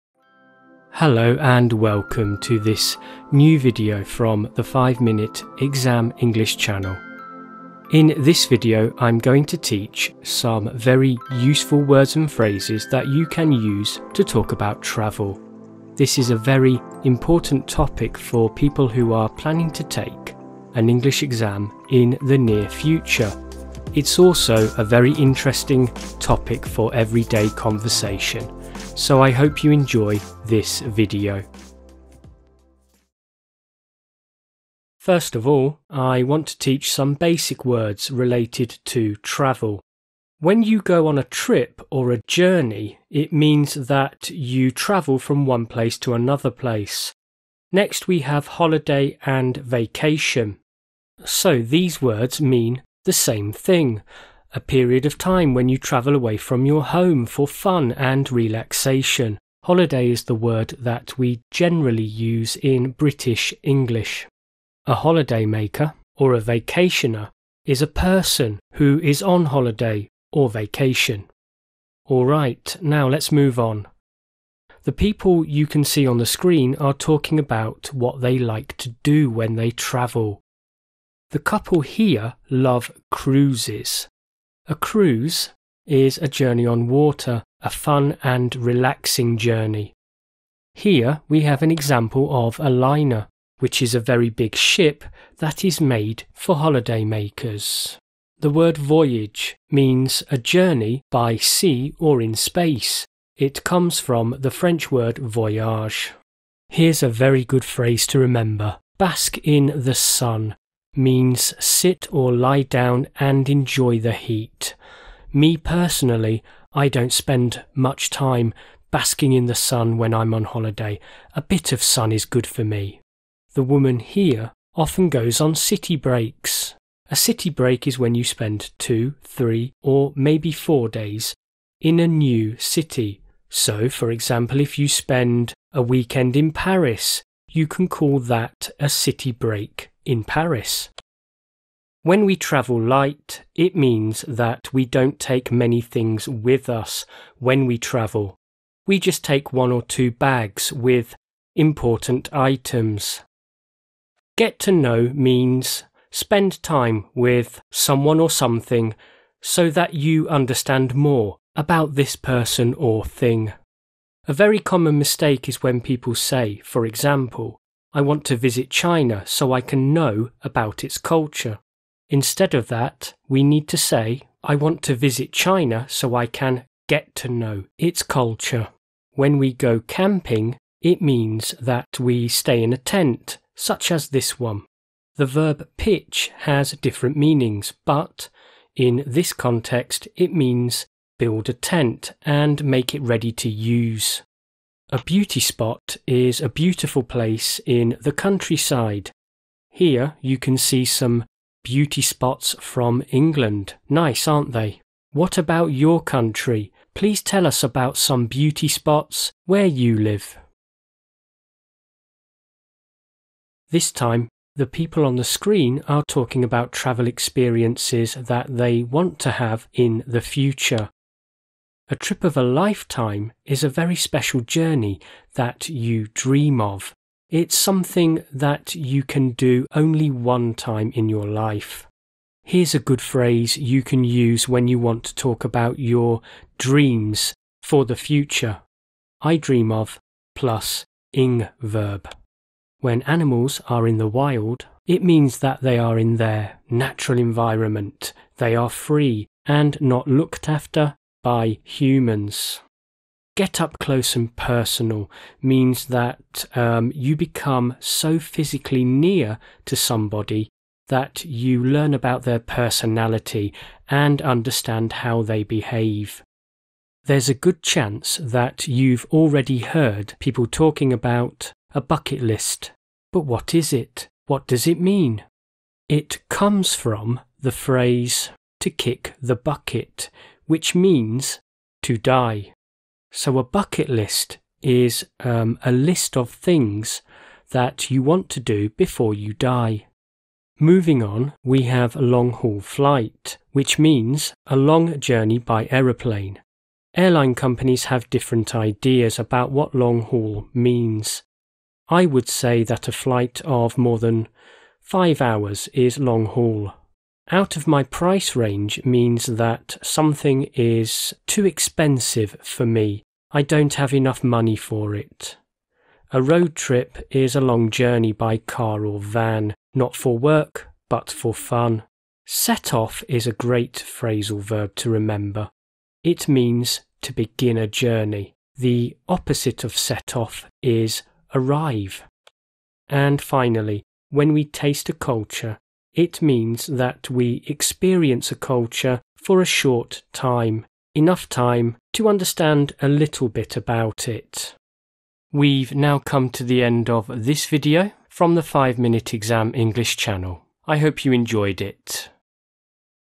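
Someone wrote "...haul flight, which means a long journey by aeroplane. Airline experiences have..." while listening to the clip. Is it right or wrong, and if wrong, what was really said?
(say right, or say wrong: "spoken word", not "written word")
wrong: "companies", not "experiences".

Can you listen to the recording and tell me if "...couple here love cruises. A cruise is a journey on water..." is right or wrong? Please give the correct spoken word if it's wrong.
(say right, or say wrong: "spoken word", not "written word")
right.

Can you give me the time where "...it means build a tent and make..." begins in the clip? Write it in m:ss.
3:10.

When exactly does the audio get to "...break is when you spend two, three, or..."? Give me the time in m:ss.
2:07.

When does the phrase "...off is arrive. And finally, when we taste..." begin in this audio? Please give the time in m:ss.
5:30.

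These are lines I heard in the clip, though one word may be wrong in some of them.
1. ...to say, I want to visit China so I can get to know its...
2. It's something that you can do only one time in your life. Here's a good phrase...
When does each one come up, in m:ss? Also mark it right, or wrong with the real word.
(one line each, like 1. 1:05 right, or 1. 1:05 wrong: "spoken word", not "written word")
1. 2:53 right
2. 3:47 right.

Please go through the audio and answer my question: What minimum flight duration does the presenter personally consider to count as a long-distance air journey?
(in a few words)
5 hours.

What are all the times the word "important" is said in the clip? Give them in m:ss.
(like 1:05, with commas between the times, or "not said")
0:17, 2:31.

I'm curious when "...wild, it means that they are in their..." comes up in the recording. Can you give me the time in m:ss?
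4:04.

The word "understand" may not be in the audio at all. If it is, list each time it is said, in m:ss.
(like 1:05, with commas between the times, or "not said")
2:40, 4:24, 5:42.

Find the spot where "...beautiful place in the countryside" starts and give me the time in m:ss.
3:16.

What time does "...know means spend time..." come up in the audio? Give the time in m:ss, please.
2:34.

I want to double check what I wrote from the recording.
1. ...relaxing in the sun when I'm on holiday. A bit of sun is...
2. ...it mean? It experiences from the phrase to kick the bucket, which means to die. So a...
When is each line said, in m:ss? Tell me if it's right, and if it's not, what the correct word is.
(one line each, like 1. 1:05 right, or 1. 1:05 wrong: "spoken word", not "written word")
1. 1:58 wrong: "basking", not "relaxing"
2. 4:34 wrong: "comes", not "experiences".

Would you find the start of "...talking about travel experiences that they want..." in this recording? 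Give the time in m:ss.
3:36.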